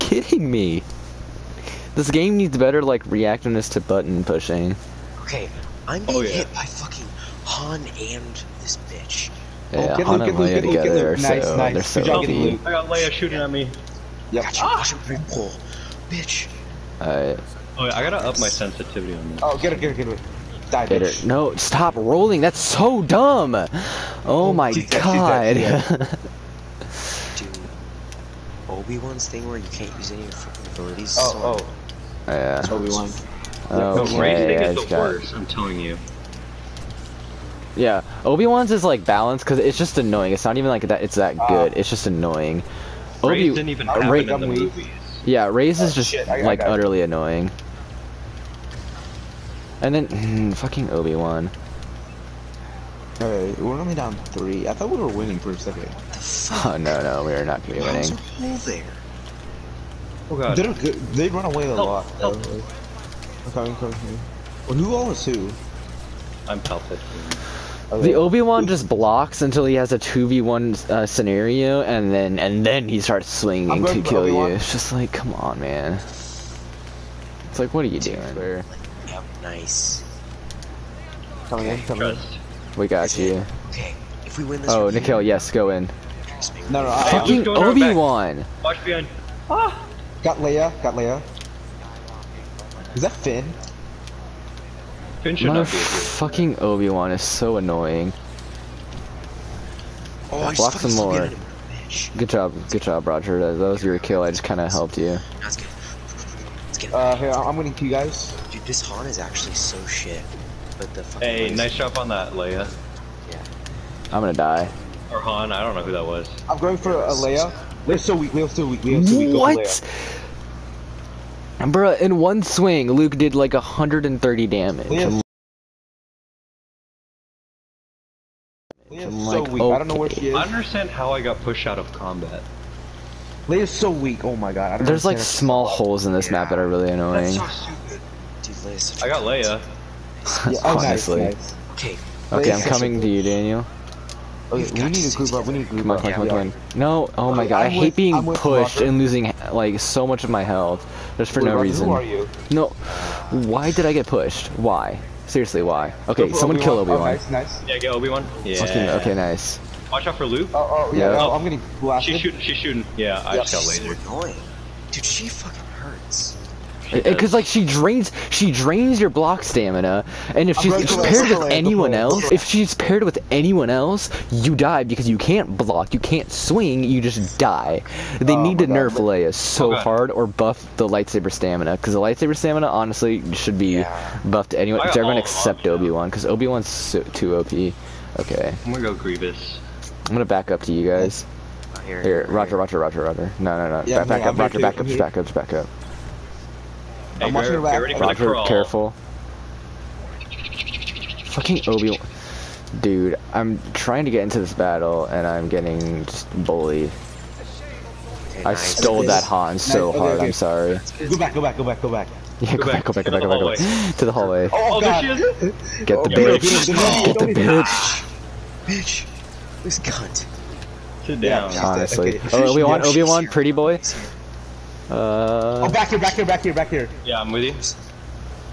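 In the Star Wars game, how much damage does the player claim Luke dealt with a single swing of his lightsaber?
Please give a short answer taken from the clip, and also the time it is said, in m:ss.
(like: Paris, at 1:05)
130, at 2:03.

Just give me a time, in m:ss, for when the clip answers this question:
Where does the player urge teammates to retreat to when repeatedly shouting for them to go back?
3:33.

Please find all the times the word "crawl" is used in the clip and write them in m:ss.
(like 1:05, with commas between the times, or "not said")
3:18.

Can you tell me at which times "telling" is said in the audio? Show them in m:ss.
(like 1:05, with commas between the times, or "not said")
0:35.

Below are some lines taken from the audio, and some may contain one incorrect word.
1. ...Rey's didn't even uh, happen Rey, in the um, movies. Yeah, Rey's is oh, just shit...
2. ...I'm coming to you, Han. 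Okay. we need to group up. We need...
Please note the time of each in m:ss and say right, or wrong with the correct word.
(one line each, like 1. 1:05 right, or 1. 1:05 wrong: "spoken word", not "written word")
1. 0:43 right
2. 2:22 wrong: "Daniel", not "Han".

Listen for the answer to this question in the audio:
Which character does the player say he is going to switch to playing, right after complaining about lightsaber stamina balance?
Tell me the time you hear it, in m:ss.
3:08.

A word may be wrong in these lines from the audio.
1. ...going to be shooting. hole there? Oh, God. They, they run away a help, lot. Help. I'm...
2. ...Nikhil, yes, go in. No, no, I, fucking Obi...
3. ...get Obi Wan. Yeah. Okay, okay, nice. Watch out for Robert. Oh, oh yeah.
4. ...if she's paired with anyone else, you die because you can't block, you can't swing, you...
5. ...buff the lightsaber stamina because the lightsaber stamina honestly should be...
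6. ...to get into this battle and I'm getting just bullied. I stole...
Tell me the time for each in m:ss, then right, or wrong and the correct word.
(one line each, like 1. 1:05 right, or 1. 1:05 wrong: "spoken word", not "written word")
1. 0:57 wrong: "winning", not "shooting"
2. 1:24 right
3. 2:37 wrong: "Luke", not "Robert"
4. 2:52 right
5. 3:00 right
6. 3:24 right.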